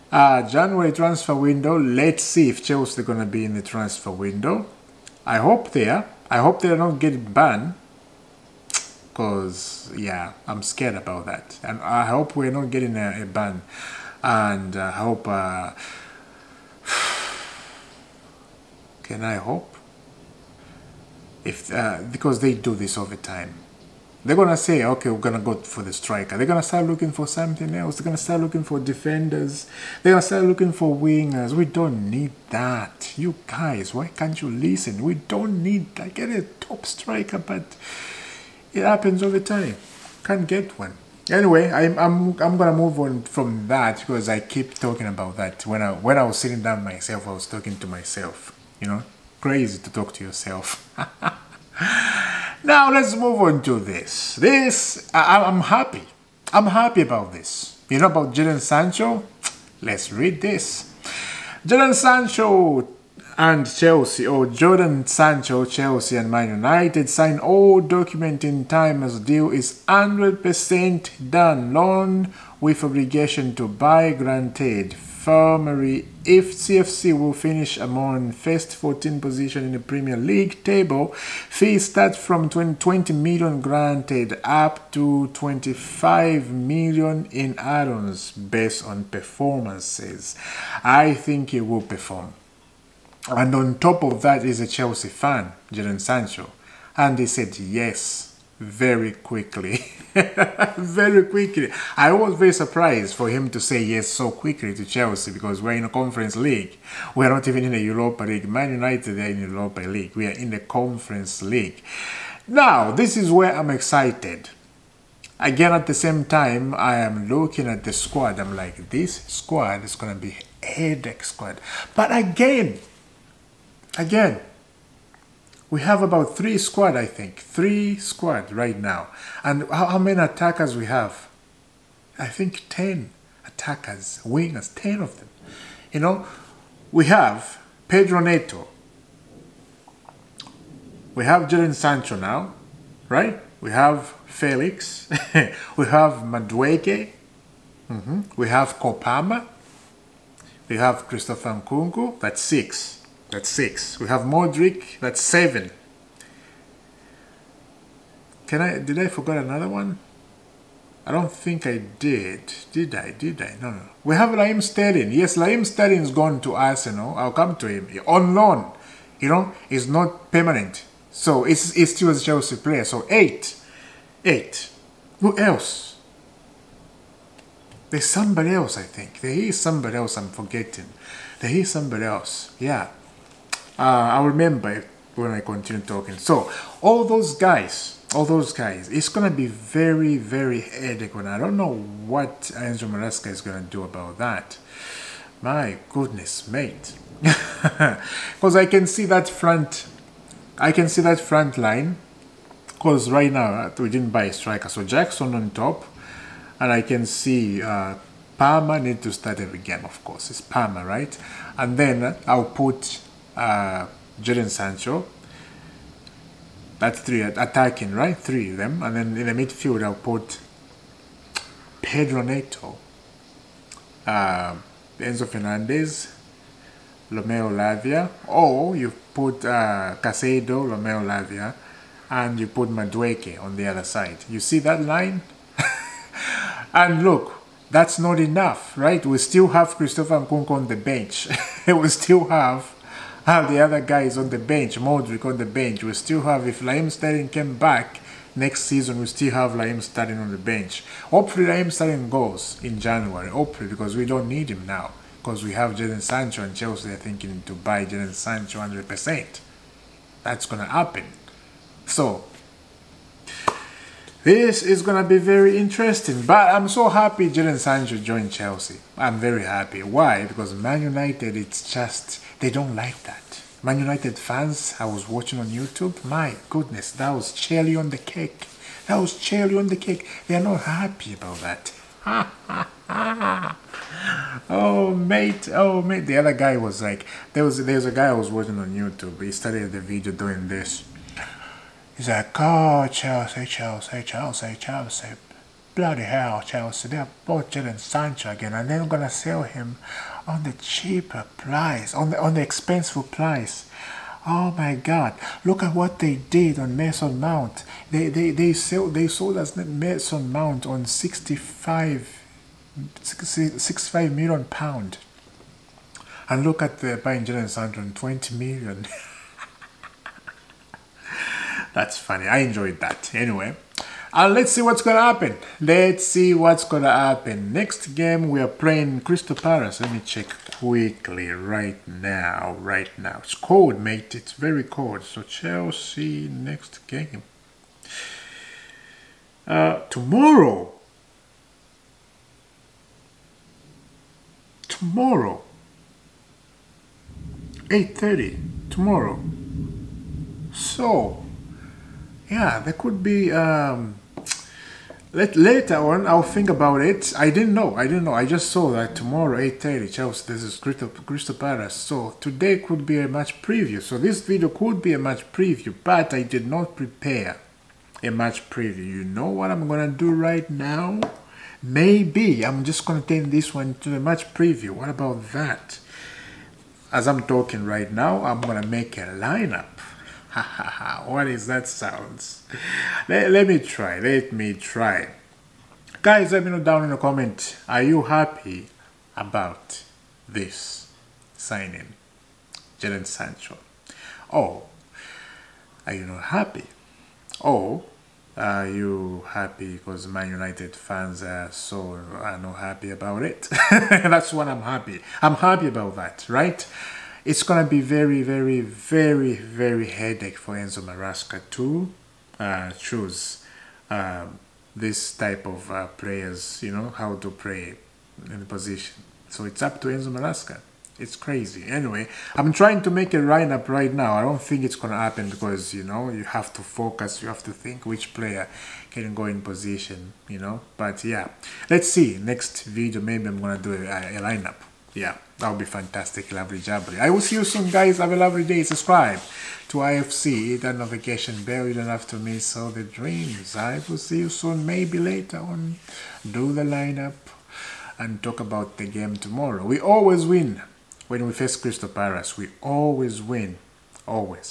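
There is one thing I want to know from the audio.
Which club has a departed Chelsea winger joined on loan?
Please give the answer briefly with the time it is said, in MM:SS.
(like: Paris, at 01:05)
Arsenal, at 02:46.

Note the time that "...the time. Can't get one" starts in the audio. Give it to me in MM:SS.
00:39.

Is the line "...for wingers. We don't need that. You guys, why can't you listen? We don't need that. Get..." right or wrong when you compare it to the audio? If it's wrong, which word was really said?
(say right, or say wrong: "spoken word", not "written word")
right.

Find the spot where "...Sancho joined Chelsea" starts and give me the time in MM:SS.
04:27.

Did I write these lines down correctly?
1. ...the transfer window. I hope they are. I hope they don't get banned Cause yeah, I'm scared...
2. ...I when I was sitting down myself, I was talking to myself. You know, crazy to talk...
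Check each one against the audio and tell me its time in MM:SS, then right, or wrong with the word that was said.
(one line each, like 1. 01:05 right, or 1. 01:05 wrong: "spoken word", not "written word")
1. 00:03 right
2. 00:45 right.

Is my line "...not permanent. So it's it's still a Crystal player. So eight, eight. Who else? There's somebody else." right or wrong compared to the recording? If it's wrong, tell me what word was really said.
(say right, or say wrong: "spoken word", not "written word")
wrong: "Chelsea", not "Crystal".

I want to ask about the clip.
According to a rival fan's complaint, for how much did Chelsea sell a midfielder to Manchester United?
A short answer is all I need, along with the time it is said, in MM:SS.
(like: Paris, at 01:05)
65 million pounds, at 05:13.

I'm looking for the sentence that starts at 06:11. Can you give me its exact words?
Maybe I'm just going to turn this one to a match preview.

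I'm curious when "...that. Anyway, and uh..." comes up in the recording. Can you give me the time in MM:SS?
05:22.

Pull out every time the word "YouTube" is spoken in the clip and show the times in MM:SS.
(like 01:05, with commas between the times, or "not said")
04:35, 04:48.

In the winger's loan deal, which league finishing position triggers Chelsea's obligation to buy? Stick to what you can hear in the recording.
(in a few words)
first 14.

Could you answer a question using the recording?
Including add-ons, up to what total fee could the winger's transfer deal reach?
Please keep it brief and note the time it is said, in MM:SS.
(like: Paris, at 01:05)
25 million, at 01:25.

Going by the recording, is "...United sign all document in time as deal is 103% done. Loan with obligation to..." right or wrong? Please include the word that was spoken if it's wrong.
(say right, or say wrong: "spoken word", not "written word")
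wrong: "100", not "103".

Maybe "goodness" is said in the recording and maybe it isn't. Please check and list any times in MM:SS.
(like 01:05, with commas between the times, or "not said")
03:15, 04:36.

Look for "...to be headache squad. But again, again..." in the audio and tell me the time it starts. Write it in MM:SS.
02:00.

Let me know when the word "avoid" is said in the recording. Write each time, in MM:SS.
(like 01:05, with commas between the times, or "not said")
not said.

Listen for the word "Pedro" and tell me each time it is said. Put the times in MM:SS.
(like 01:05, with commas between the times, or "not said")
02:17, 03:41.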